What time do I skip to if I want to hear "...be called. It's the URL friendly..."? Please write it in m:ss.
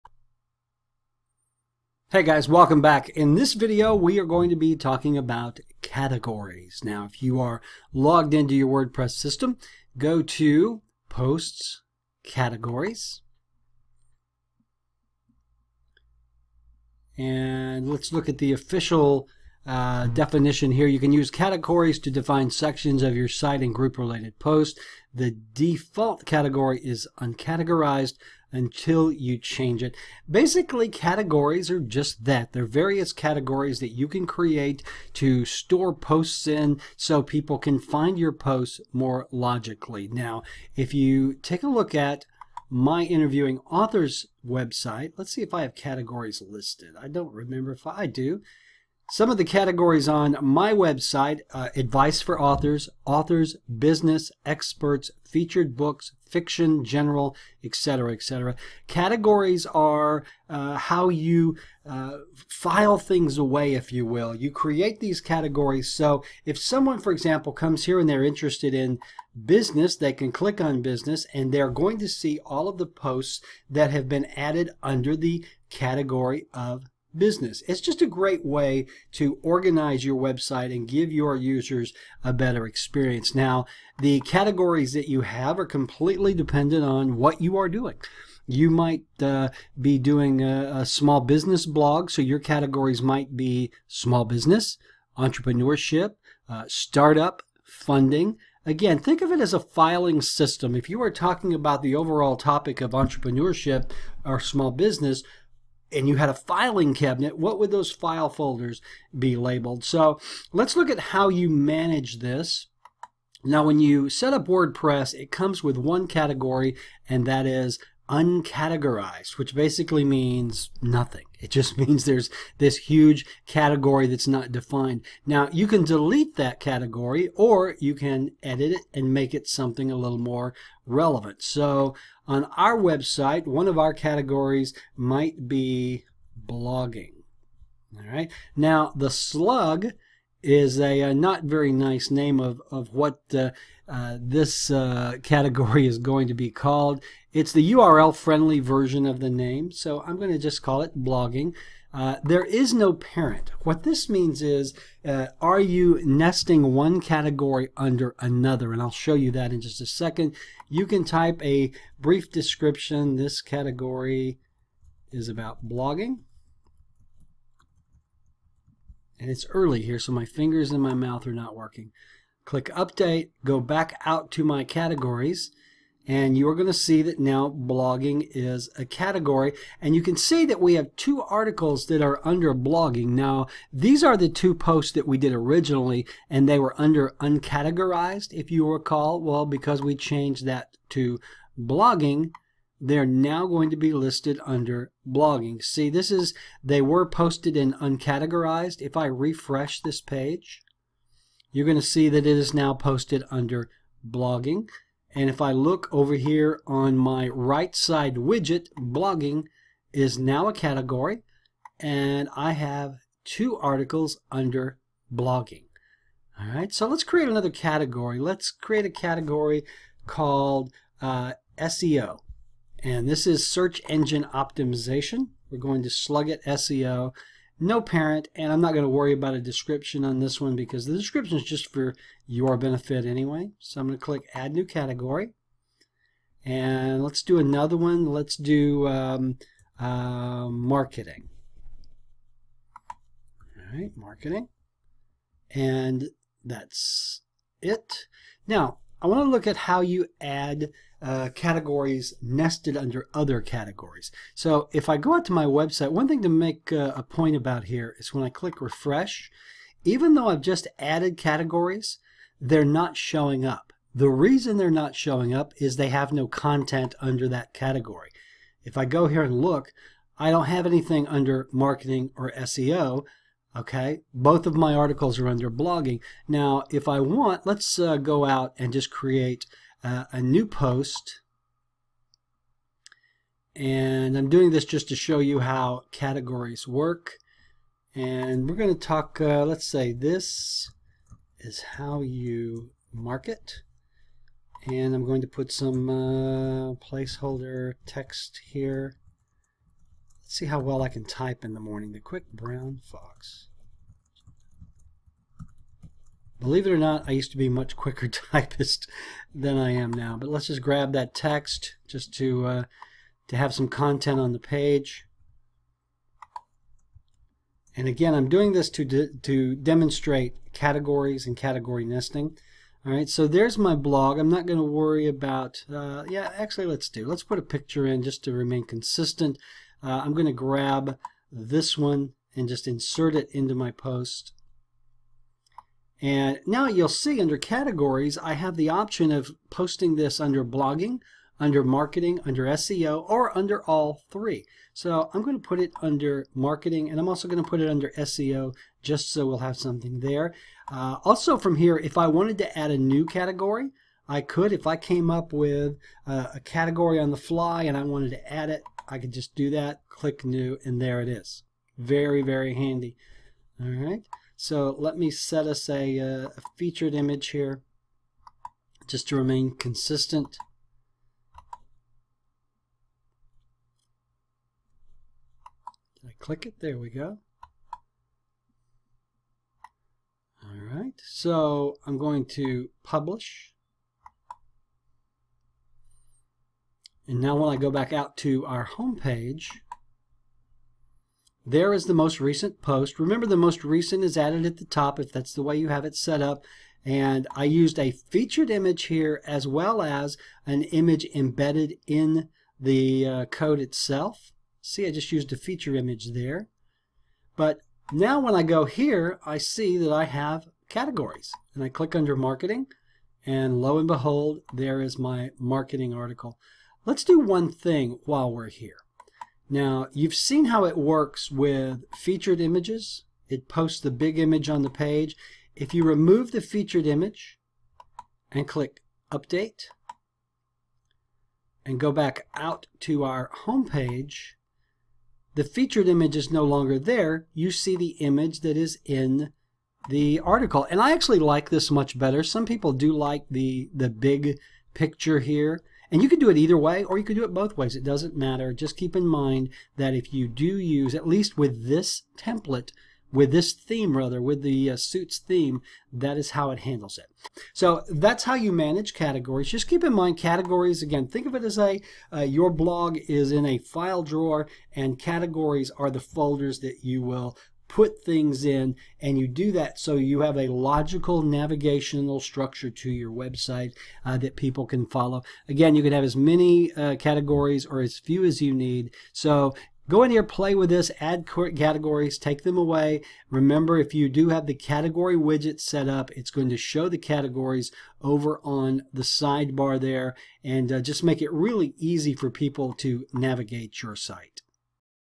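2:26.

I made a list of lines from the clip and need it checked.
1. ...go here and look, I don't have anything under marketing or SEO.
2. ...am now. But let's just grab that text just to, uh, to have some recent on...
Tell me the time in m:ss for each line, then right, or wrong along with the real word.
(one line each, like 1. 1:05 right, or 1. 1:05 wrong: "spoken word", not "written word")
1. 4:28 right
2. 5:09 wrong: "content", not "recent".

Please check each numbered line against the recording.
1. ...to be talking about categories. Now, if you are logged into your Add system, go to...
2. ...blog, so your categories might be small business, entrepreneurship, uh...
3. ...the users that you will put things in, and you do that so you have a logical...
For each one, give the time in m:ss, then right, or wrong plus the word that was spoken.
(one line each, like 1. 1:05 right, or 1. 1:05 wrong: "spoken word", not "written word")
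1. 0:04 wrong: "WordPress", not "Add"
2. 1:31 right
3. 7:45 wrong: "folders", not "users".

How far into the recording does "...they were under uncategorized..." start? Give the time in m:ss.
3:06.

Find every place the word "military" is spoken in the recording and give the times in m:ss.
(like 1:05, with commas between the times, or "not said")
not said.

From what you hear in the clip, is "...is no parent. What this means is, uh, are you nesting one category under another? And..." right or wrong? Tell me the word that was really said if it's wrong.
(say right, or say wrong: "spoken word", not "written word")
right.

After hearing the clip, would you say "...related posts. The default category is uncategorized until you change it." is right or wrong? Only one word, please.
right.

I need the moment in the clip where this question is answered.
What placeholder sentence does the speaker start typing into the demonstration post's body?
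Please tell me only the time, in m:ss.
5:01.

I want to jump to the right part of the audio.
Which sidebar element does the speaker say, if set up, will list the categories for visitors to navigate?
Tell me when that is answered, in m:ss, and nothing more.
8:04.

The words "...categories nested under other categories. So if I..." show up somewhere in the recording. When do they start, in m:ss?
4:11.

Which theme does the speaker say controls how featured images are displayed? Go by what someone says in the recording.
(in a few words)
Suits.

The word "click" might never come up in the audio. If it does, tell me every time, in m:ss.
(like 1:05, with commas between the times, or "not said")
1:10, 2:52, 3:54, 4:18, 5:59, 6:16, 6:51, 7:08.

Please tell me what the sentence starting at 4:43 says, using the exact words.
And I'm doing this just to show you how categories work.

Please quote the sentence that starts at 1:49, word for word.
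So let's look at how you manage this.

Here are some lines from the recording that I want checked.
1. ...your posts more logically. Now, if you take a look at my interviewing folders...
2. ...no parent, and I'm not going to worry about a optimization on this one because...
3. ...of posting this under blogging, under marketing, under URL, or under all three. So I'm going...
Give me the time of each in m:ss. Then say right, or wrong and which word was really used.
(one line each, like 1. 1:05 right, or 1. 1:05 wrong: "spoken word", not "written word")
1. 0:38 wrong: "authors", not "folders"
2. 3:47 wrong: "description", not "optimization"
3. 5:39 wrong: "SEO", not "URL".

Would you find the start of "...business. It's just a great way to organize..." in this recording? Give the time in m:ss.
1:17.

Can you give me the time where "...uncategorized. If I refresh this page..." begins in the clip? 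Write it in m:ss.
3:17.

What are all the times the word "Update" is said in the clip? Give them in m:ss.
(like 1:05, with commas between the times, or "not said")
2:52, 7:09.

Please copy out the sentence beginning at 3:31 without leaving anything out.
And I have two articles under blogging.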